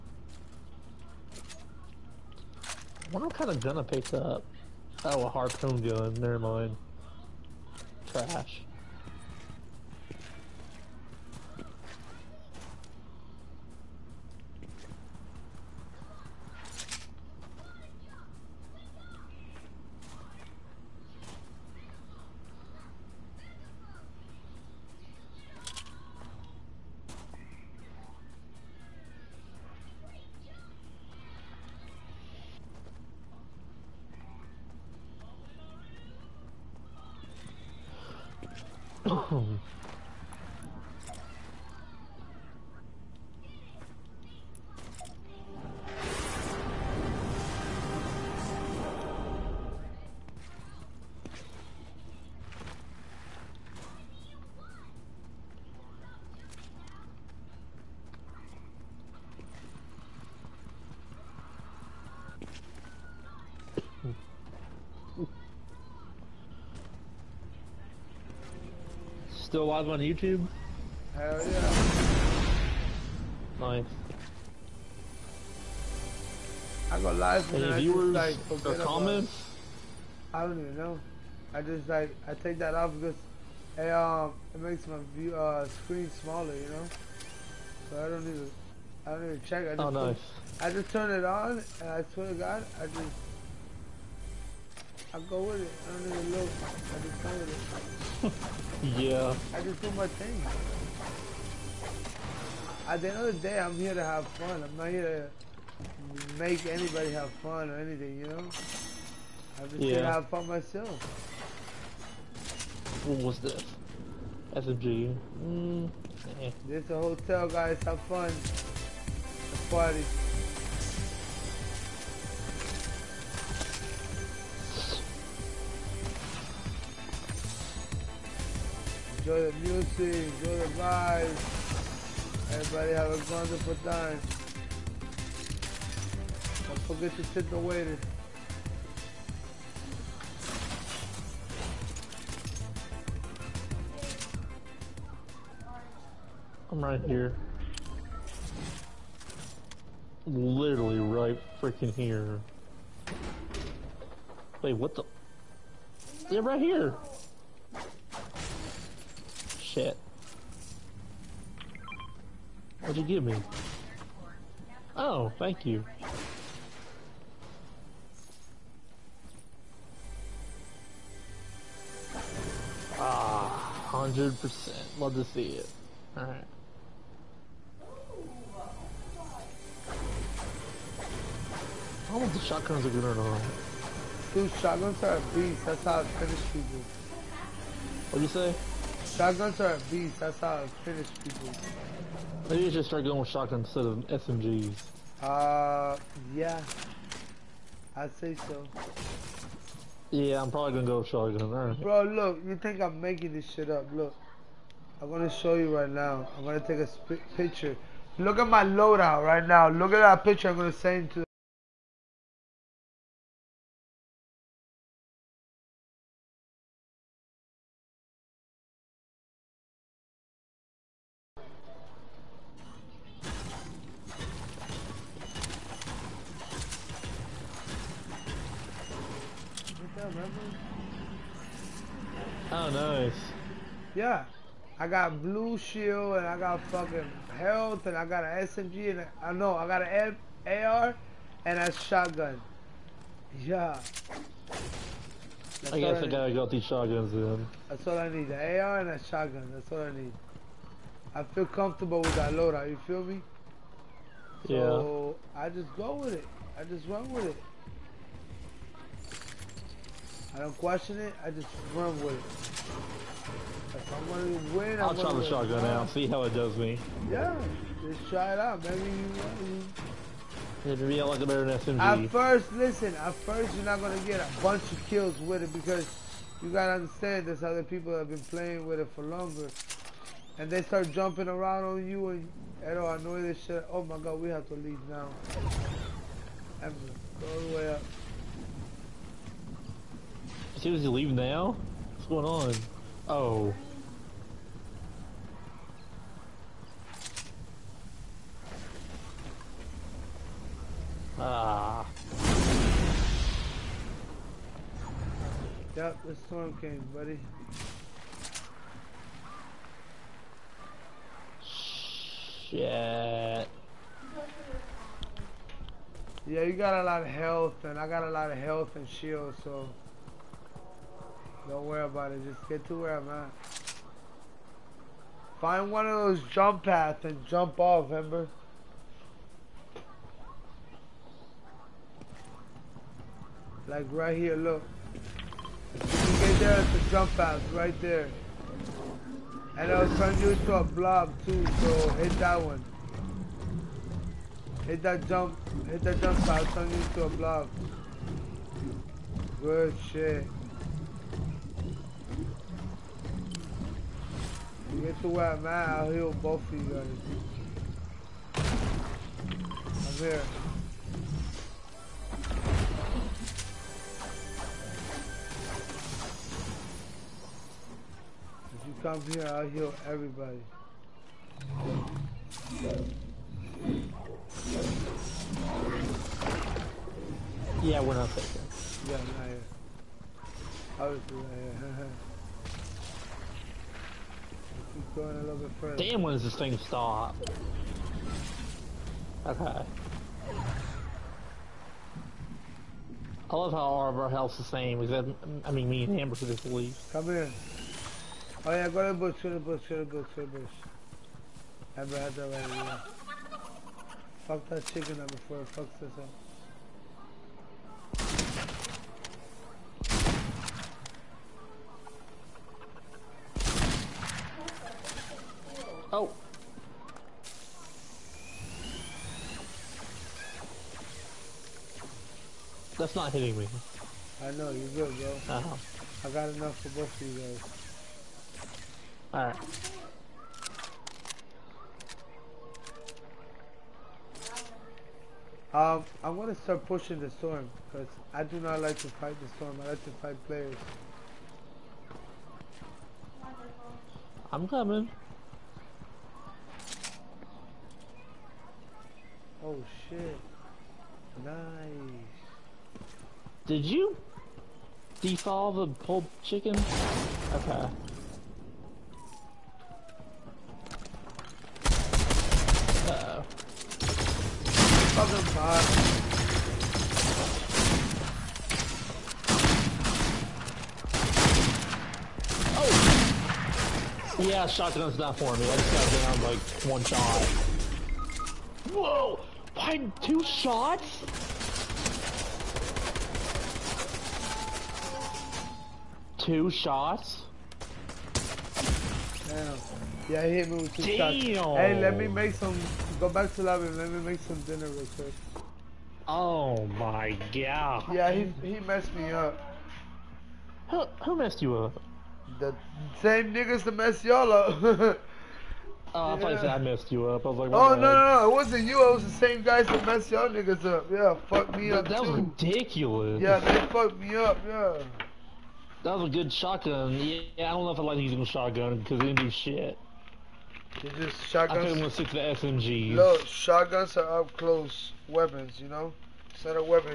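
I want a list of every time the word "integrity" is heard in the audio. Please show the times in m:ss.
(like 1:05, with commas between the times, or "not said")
not said.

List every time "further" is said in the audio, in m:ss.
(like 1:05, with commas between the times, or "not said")
6:25.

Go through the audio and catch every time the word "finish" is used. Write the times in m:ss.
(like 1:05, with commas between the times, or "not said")
3:06, 3:10.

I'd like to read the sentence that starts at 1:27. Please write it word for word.
So I don't even I don't even check.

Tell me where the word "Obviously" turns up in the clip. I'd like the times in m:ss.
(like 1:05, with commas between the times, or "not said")
6:20.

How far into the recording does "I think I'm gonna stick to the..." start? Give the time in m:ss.
8:41.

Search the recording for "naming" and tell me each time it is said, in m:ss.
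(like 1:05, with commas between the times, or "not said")
not said.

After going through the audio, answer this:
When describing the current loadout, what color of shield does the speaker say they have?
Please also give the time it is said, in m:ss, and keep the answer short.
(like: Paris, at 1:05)
blue, at 3:55.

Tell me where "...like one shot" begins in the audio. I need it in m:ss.
7:56.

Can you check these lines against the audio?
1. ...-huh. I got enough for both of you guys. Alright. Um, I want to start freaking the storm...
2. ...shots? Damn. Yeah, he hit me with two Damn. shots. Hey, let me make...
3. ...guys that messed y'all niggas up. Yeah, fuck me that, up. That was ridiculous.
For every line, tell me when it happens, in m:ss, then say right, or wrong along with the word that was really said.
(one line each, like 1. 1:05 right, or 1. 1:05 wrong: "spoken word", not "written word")
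1. 7:05 wrong: "pushing", not "freaking"
2. 8:06 right
3. 8:29 right.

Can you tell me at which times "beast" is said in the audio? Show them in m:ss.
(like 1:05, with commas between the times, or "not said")
3:05, 3:09.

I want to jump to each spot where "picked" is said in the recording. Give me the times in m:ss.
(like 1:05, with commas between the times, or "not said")
0:03.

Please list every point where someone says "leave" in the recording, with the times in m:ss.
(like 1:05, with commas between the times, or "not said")
4:44, 4:50, 6:36.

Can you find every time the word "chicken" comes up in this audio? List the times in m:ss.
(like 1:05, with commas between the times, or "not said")
6:44, 7:36.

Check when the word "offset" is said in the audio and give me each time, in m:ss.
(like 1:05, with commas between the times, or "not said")
not said.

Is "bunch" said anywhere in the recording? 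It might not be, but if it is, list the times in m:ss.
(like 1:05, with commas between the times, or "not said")
4:34.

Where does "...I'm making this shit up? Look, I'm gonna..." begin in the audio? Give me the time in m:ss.
3:22.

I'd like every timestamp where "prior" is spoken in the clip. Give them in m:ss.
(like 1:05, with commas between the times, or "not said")
not said.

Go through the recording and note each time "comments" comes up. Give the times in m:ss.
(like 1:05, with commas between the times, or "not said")
1:18.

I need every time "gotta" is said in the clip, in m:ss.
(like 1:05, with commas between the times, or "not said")
4:06, 4:36.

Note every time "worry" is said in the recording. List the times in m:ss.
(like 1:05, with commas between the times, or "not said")
5:21.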